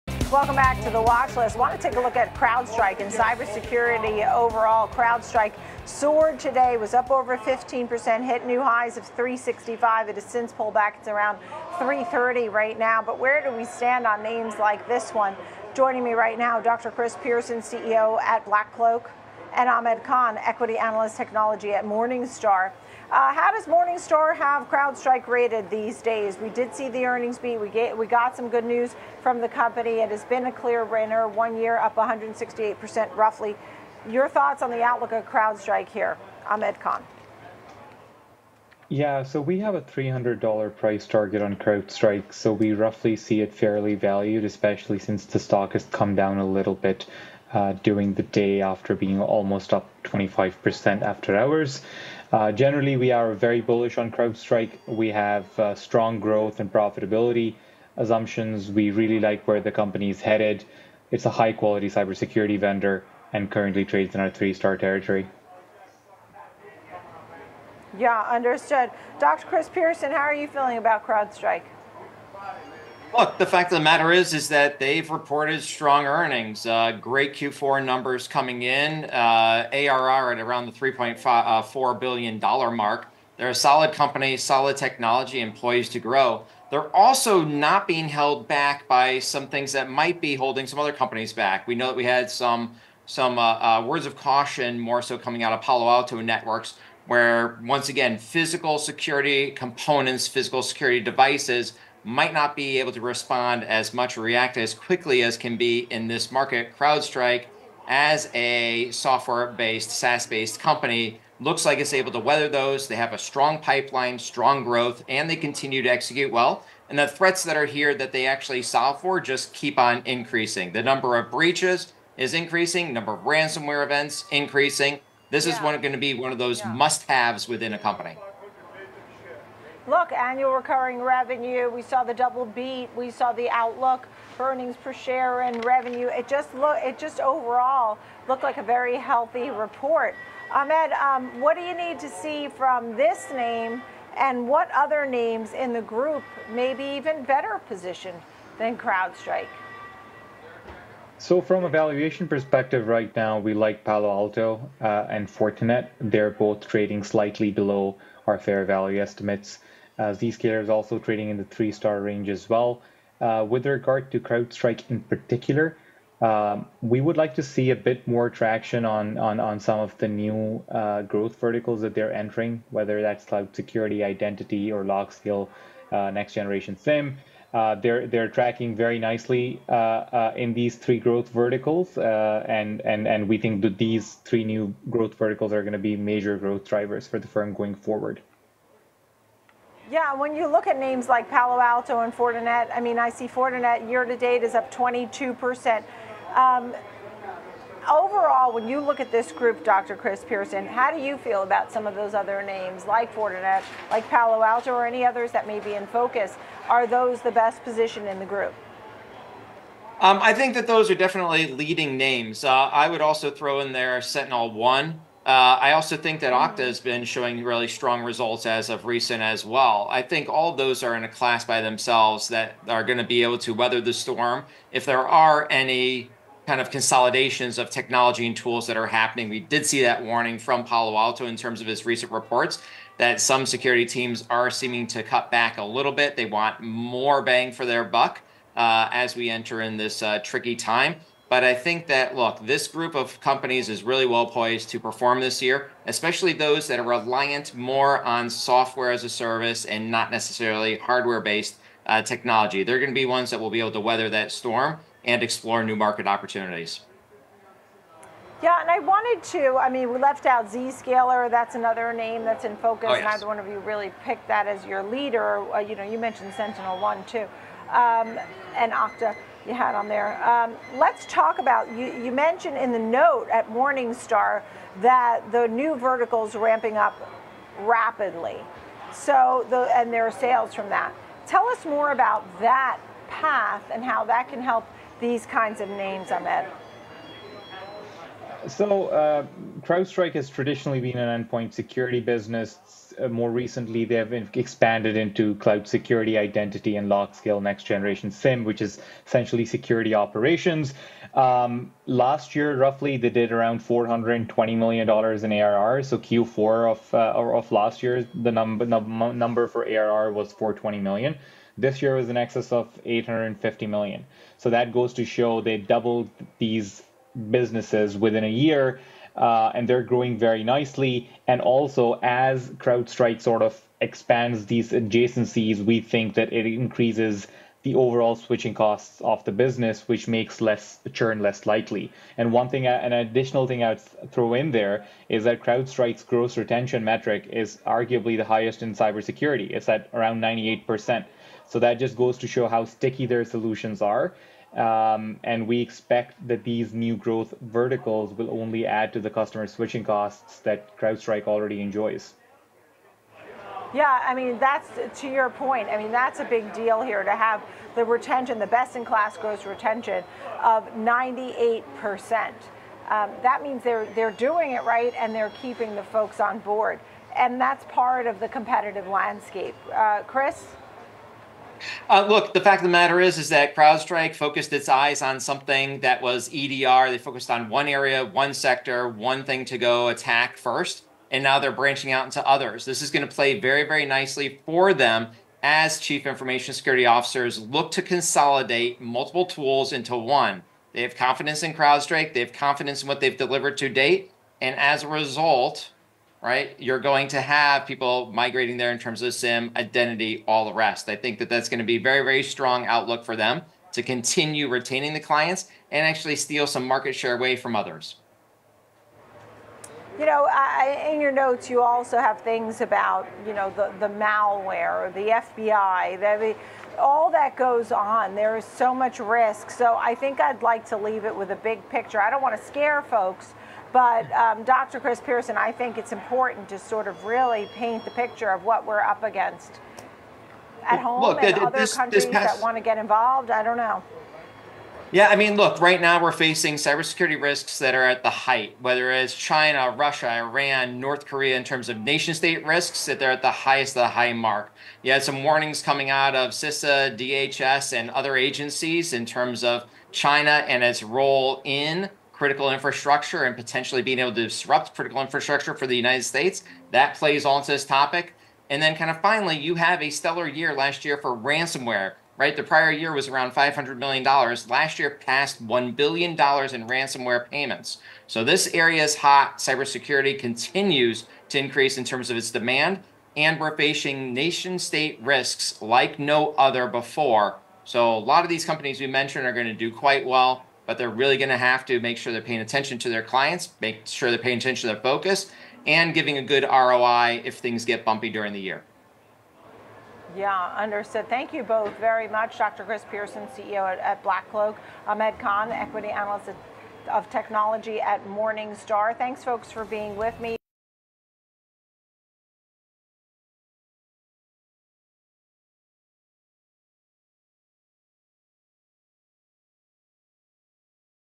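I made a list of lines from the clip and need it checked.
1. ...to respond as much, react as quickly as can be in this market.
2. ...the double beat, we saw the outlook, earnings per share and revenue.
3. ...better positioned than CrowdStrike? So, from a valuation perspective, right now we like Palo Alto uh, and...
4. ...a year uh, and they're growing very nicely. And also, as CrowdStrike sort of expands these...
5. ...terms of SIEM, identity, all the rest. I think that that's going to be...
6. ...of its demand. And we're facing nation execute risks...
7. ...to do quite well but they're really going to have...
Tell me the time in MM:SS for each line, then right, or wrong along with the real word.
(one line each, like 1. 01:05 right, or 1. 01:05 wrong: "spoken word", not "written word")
1. 01:42 right
2. 02:12 right
3. 02:27 right
4. 05:18 right
5. 06:38 right
6. 07:52 wrong: "state", not "execute"
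7. 07:59 right.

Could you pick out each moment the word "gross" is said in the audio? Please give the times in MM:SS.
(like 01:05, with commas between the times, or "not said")
05:36, 05:59.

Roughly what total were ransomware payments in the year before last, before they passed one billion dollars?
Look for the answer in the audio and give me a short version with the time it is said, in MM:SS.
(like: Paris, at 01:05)
$500 million, at 07:43.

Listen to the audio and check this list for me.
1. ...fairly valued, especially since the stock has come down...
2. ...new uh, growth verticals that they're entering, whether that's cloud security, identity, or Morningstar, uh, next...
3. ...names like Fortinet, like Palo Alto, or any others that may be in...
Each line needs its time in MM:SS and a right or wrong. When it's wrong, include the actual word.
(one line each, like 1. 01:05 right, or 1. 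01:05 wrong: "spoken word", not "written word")
1. 00:43 right
2. 02:50 wrong: "LogScale", not "Morningstar"
3. 03:22 right.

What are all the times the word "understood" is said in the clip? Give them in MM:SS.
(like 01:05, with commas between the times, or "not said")
01:08, 08:10.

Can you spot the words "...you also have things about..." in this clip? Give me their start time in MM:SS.
06:51.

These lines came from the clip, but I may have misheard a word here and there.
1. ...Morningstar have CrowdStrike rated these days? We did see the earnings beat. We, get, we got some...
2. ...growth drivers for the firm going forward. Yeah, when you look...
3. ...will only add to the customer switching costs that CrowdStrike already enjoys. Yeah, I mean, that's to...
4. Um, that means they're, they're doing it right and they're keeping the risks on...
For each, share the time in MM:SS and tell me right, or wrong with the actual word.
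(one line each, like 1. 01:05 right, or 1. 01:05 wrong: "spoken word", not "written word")
1. 00:23 right
2. 03:06 right
3. 05:48 right
4. 06:02 wrong: "folks", not "risks".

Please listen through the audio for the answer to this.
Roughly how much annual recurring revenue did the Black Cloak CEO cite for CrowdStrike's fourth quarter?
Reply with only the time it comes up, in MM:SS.
01:20.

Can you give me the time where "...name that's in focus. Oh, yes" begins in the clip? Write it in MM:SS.
04:21.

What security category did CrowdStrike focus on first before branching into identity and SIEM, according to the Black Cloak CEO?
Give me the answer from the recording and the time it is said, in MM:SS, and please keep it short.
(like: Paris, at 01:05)
EDR, at 06:16.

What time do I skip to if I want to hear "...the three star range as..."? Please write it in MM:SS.
02:41.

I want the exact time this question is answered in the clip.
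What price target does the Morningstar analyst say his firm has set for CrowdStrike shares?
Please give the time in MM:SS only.
00:39.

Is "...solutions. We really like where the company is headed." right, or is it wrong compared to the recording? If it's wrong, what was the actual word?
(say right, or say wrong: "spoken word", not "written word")
wrong: "assumptions", not "solutions".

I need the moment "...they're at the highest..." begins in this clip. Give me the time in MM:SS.
07:22.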